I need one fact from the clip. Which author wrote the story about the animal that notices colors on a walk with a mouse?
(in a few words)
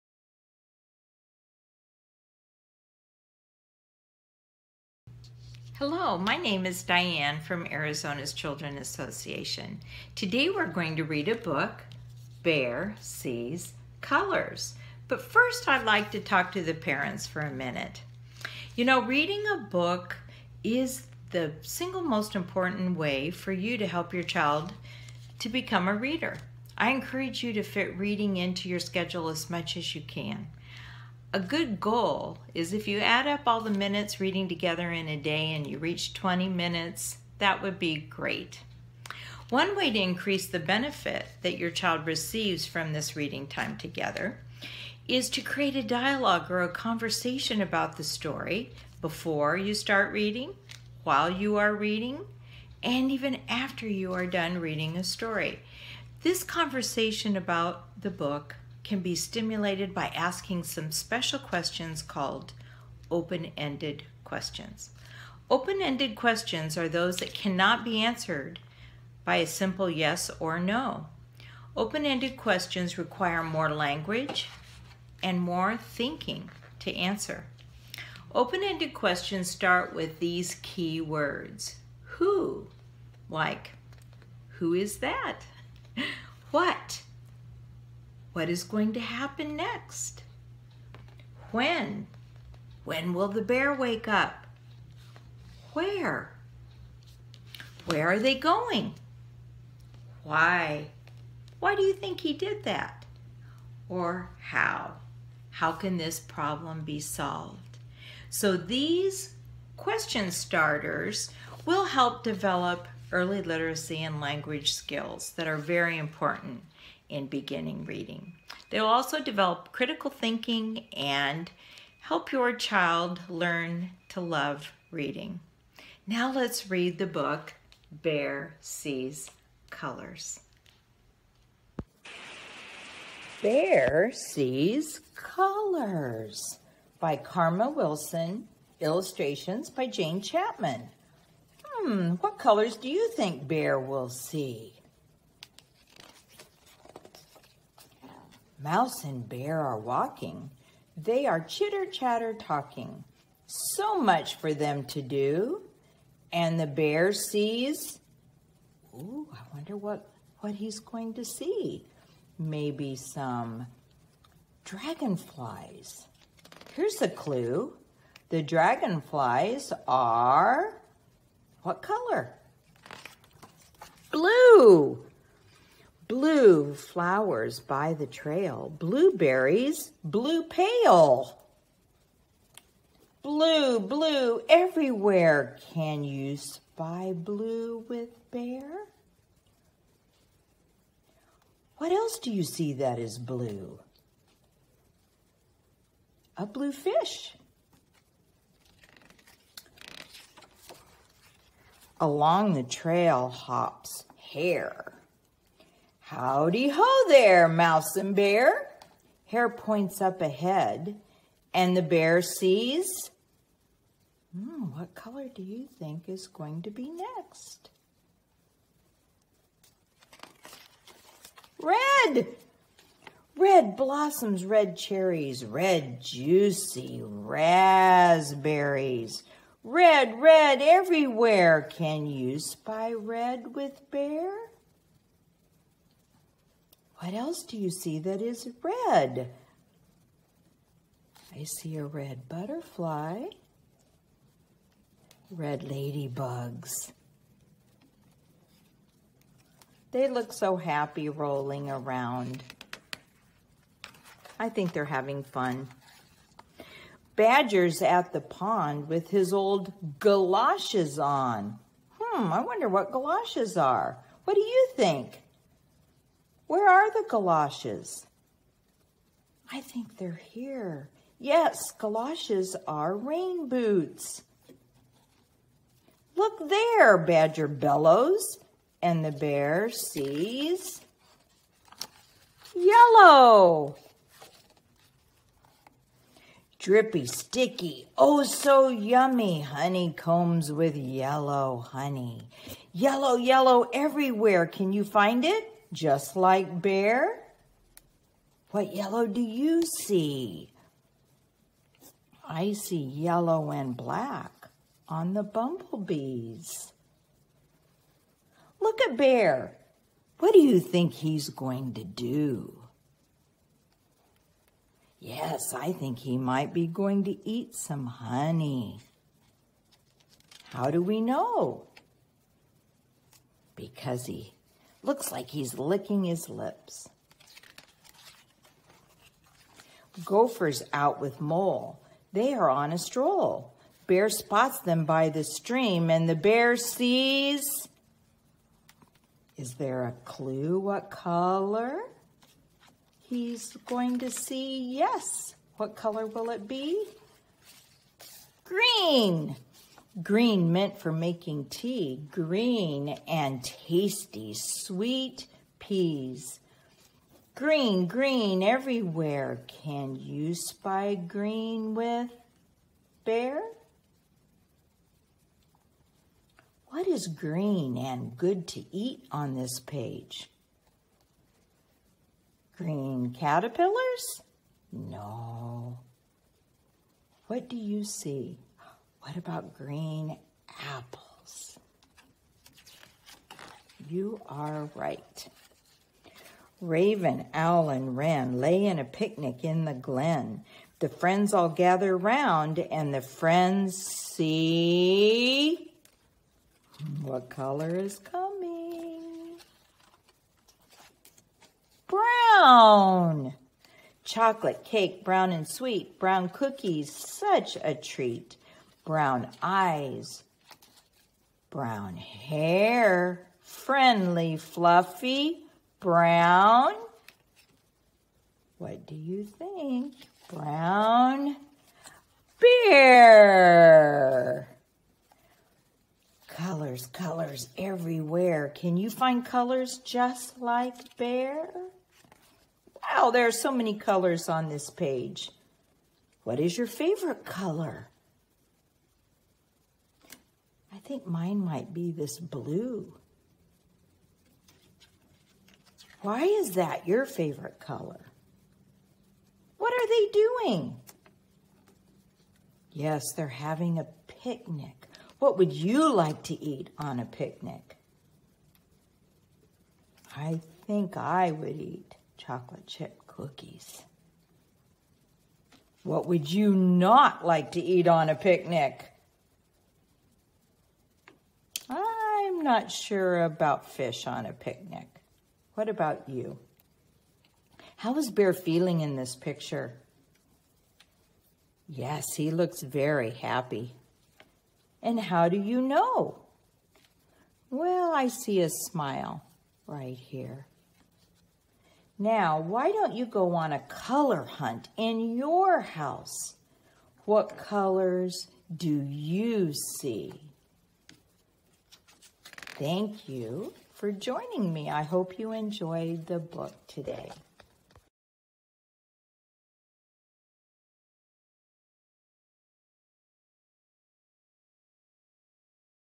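Karma Wilson.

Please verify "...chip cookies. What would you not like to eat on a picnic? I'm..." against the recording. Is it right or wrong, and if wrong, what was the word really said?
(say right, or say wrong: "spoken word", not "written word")
right.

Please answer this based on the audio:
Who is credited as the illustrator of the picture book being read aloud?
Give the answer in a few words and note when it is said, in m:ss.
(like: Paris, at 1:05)
Jane Chapman, at 2:19.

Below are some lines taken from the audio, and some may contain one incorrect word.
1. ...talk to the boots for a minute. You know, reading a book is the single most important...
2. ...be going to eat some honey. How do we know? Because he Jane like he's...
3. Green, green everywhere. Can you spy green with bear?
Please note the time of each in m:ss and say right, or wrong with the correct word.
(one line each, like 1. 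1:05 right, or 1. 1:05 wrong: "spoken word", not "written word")
1. 0:16 wrong: "parents", not "boots"
2. 5:16 wrong: "Looks", not "Jane"
3. 5:57 right.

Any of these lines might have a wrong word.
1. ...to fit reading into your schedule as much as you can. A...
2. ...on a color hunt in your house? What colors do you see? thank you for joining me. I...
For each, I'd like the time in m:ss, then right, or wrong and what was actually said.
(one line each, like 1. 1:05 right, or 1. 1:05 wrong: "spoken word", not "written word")
1. 0:27 right
2. 8:13 right.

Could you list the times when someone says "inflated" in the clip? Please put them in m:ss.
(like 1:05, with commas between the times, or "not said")
not said.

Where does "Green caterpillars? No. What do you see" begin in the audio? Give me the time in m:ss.
6:12.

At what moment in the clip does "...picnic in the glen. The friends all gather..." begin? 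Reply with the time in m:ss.
6:28.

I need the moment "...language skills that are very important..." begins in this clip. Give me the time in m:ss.
1:54.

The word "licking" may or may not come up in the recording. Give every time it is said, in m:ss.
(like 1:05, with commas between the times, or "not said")
5:25.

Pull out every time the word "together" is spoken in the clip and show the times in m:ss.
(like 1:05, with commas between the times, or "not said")
0:34, 0:43.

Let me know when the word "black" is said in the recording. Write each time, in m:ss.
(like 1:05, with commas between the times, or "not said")
5:03.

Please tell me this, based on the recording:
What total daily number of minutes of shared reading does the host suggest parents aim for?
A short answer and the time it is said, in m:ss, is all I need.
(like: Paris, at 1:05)
20, at 0:36.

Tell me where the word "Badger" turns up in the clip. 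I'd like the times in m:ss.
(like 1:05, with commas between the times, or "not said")
4:17, 4:36.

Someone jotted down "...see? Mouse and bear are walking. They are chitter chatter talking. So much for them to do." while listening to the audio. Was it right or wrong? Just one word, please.
right.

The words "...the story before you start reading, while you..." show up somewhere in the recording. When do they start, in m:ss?
0:47.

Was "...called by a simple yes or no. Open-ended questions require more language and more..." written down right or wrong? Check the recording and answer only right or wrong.
wrong.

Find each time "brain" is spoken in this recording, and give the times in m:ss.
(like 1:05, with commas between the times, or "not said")
not said.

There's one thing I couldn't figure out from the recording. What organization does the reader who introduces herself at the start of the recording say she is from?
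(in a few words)
Arizona's Children Association.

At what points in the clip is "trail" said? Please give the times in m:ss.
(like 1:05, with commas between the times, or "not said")
2:58, 3:22.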